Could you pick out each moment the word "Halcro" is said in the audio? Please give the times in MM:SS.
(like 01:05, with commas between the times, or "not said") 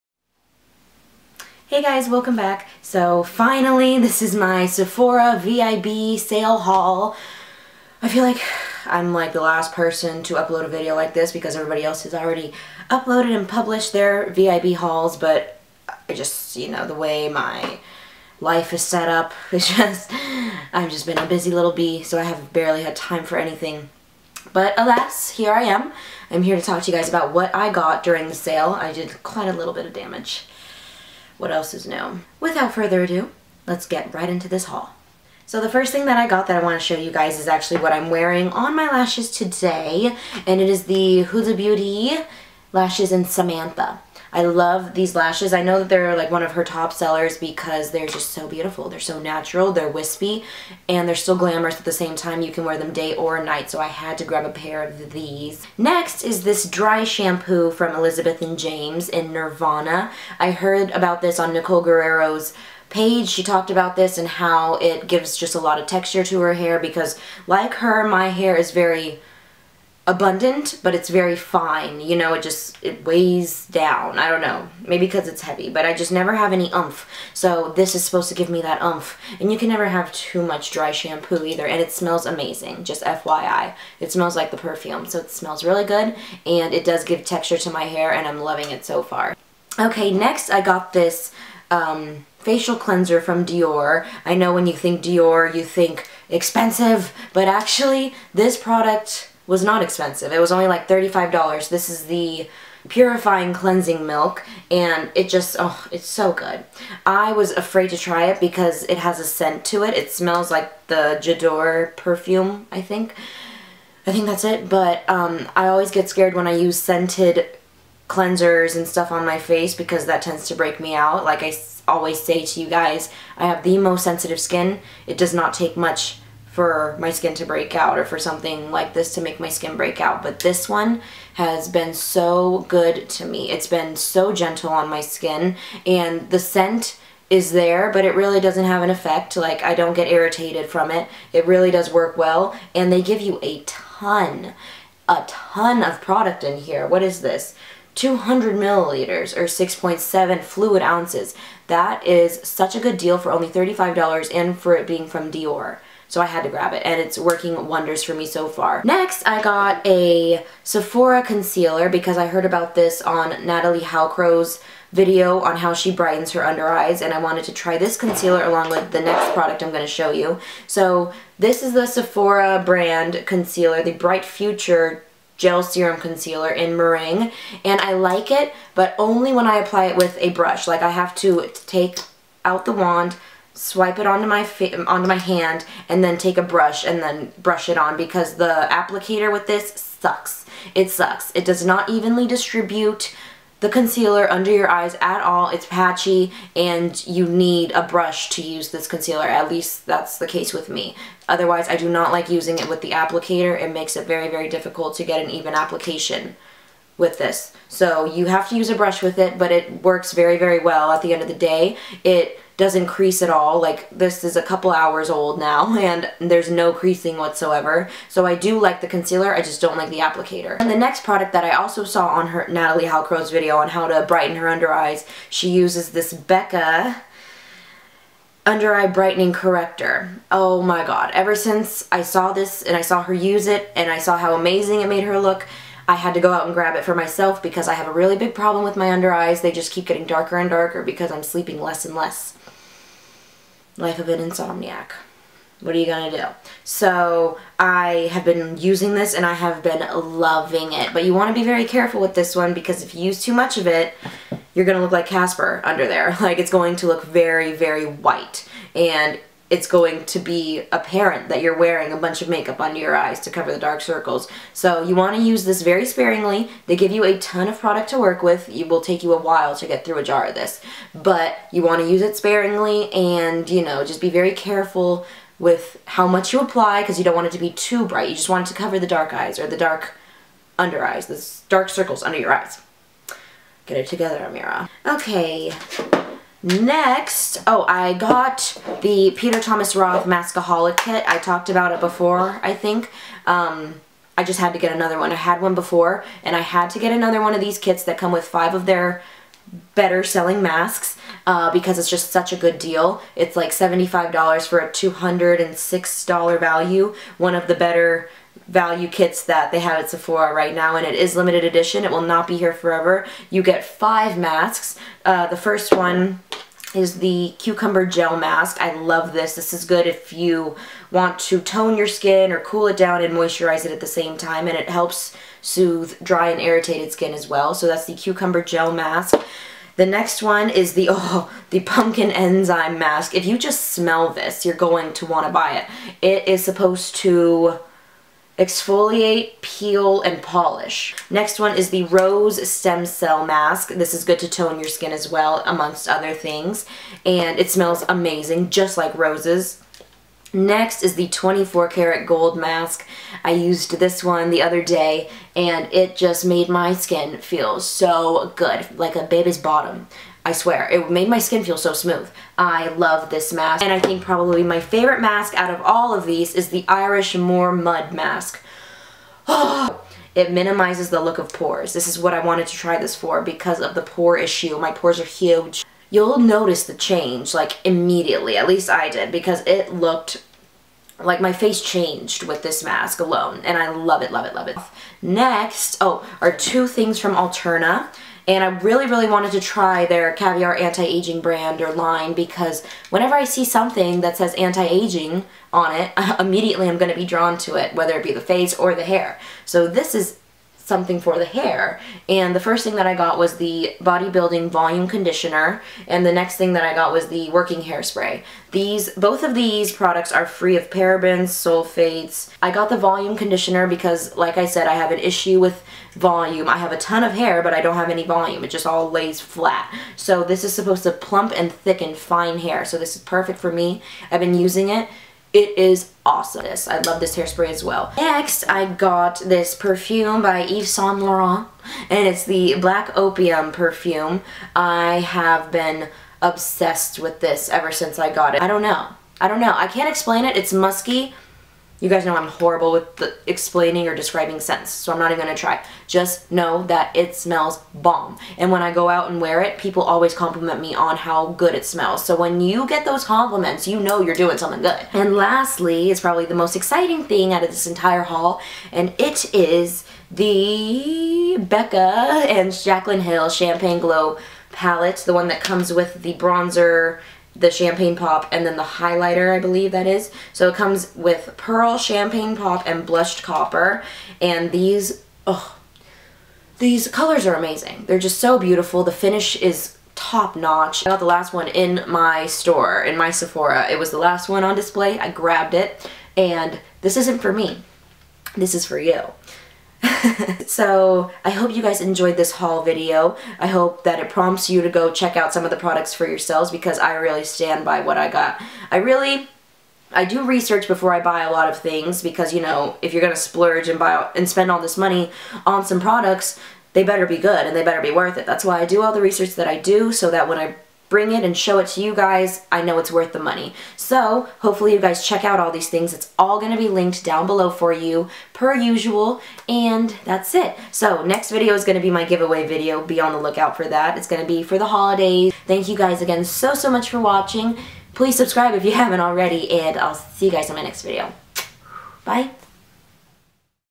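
02:43, 03:42.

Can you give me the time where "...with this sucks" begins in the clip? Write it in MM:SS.
03:09.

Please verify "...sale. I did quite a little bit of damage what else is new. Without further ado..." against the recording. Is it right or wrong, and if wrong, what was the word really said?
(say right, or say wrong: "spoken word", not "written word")
right.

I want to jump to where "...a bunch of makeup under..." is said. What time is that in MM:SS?
04:21.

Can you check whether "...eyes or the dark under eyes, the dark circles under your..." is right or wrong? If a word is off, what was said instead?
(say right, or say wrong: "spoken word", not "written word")
right.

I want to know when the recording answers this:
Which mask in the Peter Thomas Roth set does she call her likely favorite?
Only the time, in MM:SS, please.
06:06.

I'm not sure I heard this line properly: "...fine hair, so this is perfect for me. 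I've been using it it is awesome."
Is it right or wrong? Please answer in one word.
right.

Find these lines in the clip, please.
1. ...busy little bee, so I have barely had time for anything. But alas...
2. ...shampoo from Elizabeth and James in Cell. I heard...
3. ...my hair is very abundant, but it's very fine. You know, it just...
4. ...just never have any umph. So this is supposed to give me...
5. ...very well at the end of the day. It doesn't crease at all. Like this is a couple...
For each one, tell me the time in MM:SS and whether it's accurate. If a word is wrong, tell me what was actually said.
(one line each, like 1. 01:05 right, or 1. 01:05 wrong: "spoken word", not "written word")
1. 00:21 right
2. 00:57 wrong: "Nirvana", not "Cell"
3. 01:08 right
4. 01:15 right
5. 03:30 right.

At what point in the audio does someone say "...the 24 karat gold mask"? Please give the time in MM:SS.
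05:50.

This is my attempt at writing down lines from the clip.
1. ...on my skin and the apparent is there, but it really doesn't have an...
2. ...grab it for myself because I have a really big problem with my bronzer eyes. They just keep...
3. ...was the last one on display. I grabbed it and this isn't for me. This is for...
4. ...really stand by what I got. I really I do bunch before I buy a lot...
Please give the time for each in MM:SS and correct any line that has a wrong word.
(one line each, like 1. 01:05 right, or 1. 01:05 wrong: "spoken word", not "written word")
1. 02:14 wrong: "scent", not "apparent"
2. 03:56 wrong: "under", not "bronzer"
3. 08:03 right
4. 08:16 wrong: "research", not "bunch".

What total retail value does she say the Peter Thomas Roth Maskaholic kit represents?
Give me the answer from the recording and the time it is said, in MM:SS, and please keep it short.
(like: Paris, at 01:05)
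$206, at 05:04.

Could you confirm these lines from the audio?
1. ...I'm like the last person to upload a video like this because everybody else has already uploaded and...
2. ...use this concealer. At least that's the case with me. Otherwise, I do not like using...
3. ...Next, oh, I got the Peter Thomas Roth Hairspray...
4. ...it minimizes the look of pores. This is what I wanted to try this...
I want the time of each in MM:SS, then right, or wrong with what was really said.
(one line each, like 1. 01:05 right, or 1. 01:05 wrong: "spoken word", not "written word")
1. 00:08 right
2. 03:18 right
3. 04:46 wrong: "Maskaholic", not "Hairspray"
4. 06:10 right.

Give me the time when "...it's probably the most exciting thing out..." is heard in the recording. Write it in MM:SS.
07:35.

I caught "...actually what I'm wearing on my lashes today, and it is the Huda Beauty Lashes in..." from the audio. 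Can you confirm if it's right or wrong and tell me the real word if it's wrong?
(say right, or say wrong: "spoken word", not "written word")
right.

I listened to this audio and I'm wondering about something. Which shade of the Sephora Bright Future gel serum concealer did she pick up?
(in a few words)
Meringue.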